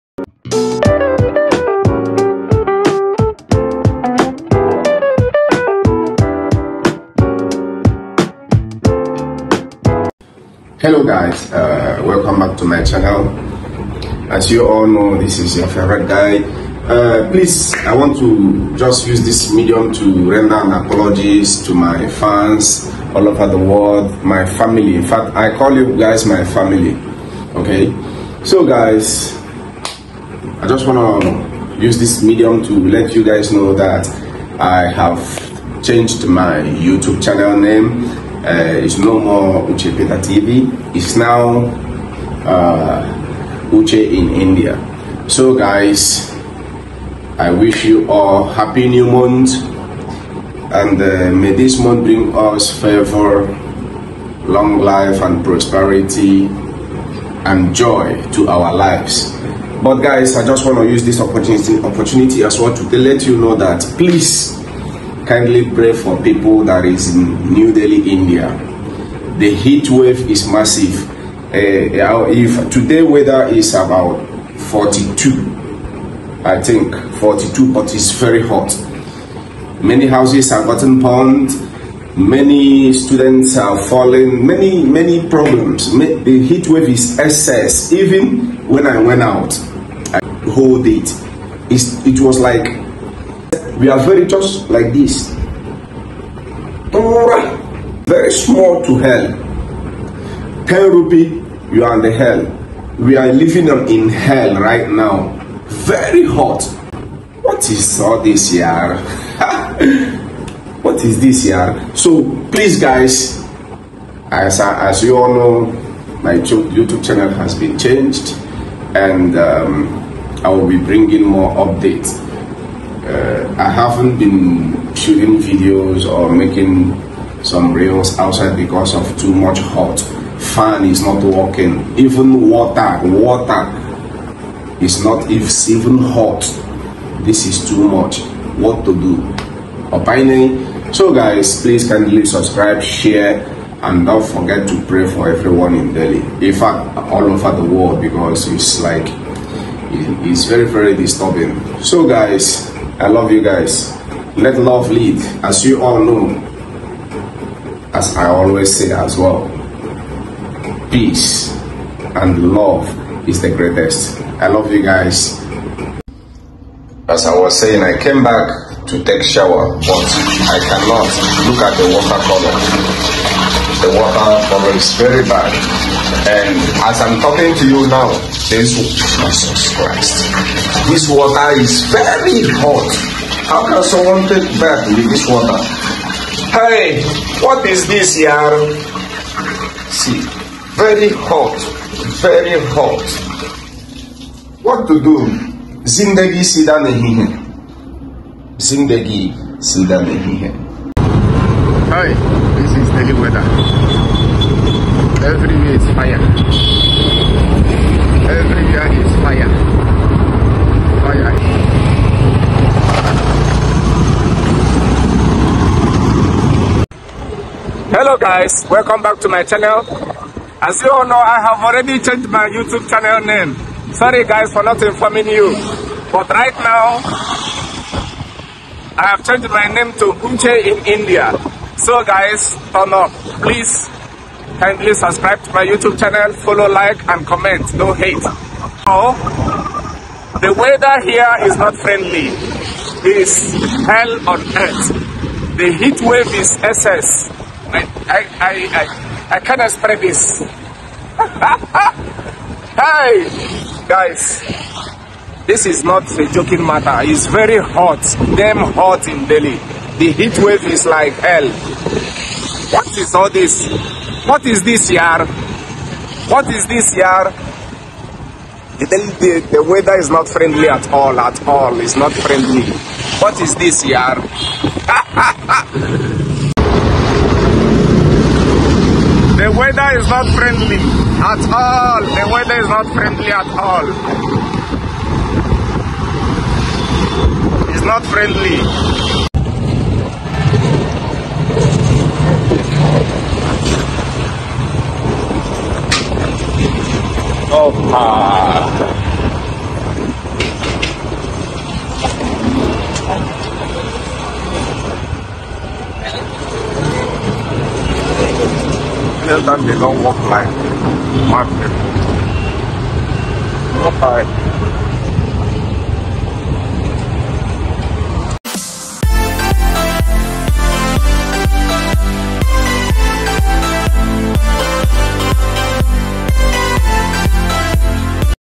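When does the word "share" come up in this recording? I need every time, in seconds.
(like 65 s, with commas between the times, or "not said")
142 s.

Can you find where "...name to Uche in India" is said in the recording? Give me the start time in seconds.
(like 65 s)
229 s.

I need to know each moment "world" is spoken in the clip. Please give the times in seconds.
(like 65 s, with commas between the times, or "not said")
23 s, 147 s.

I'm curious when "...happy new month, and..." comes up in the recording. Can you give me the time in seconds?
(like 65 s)
48 s.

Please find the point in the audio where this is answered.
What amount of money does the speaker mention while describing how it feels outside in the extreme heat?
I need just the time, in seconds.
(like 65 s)
100 s.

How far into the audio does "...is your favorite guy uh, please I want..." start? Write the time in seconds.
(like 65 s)
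15 s.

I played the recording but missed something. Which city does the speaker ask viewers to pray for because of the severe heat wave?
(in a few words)
New Delhi.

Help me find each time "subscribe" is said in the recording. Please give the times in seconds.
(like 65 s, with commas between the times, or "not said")
142 s, 234 s.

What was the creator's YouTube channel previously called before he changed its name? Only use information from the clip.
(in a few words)
Uche Peter TV.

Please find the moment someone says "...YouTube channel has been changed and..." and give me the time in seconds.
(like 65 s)
116 s.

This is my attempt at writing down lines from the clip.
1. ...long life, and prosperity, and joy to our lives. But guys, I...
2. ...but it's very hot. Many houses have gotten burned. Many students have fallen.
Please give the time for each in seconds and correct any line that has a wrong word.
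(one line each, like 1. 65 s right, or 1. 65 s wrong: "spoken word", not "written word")
1. 54 s right
2. 77 s right.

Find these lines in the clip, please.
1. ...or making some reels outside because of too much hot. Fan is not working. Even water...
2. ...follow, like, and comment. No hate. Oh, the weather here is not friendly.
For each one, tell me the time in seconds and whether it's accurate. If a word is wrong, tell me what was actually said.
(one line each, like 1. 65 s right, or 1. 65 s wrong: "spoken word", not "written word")
1. 126 s right
2. 236 s right.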